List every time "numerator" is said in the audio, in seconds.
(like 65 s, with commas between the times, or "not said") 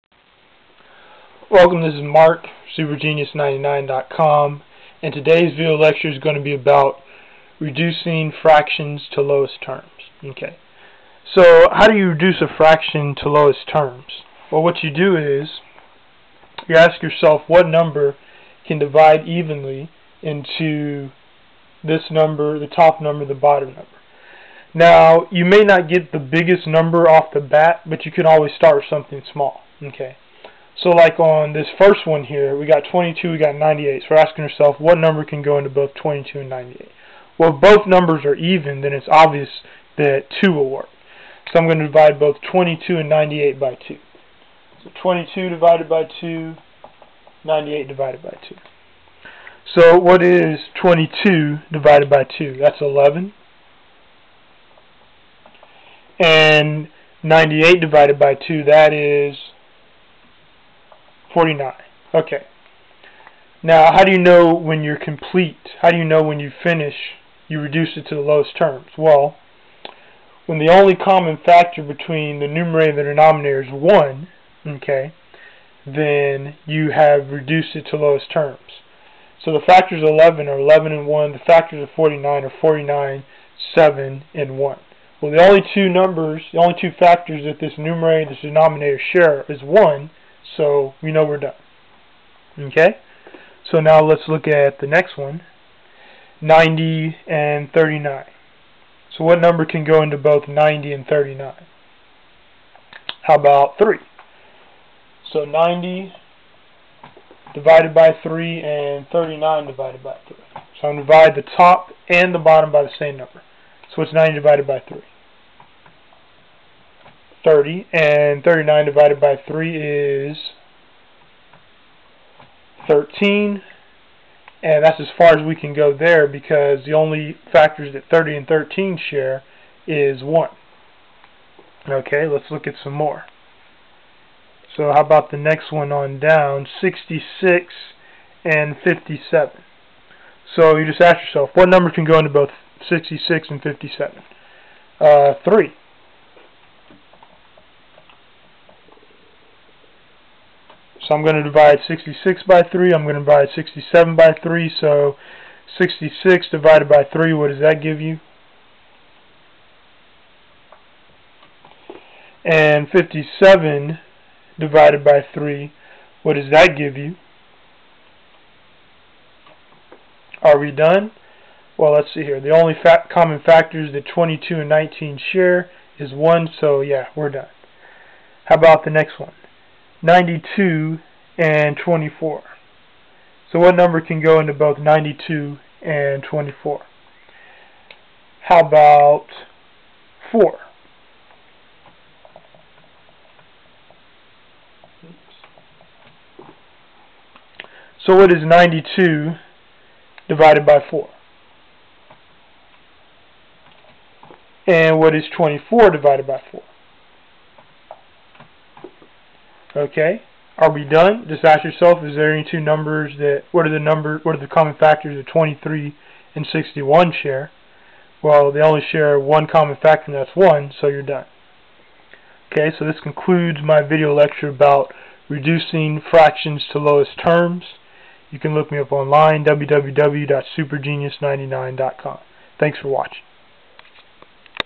72 s, 87 s.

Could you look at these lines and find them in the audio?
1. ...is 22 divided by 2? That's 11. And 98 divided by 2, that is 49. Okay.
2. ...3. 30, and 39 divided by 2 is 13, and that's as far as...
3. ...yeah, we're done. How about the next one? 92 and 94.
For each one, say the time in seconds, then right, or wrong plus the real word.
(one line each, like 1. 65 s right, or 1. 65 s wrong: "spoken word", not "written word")
1. 50 s right
2. 114 s wrong: "3", not "2"
3. 176 s wrong: "24", not "94".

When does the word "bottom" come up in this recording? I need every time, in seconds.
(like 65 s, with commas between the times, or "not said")
23 s, 112 s.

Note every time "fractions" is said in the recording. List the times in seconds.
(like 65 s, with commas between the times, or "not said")
8 s, 12 s, 226 s.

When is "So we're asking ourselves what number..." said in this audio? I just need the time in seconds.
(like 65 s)
34 s.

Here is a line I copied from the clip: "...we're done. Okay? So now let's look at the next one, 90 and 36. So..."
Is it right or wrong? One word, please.
wrong.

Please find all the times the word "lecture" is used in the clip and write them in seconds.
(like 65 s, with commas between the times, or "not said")
5 s, 224 s.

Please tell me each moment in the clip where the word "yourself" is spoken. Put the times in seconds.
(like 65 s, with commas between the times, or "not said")
17 s, 141 s, 211 s.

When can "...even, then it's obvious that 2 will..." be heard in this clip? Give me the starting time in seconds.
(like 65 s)
38 s.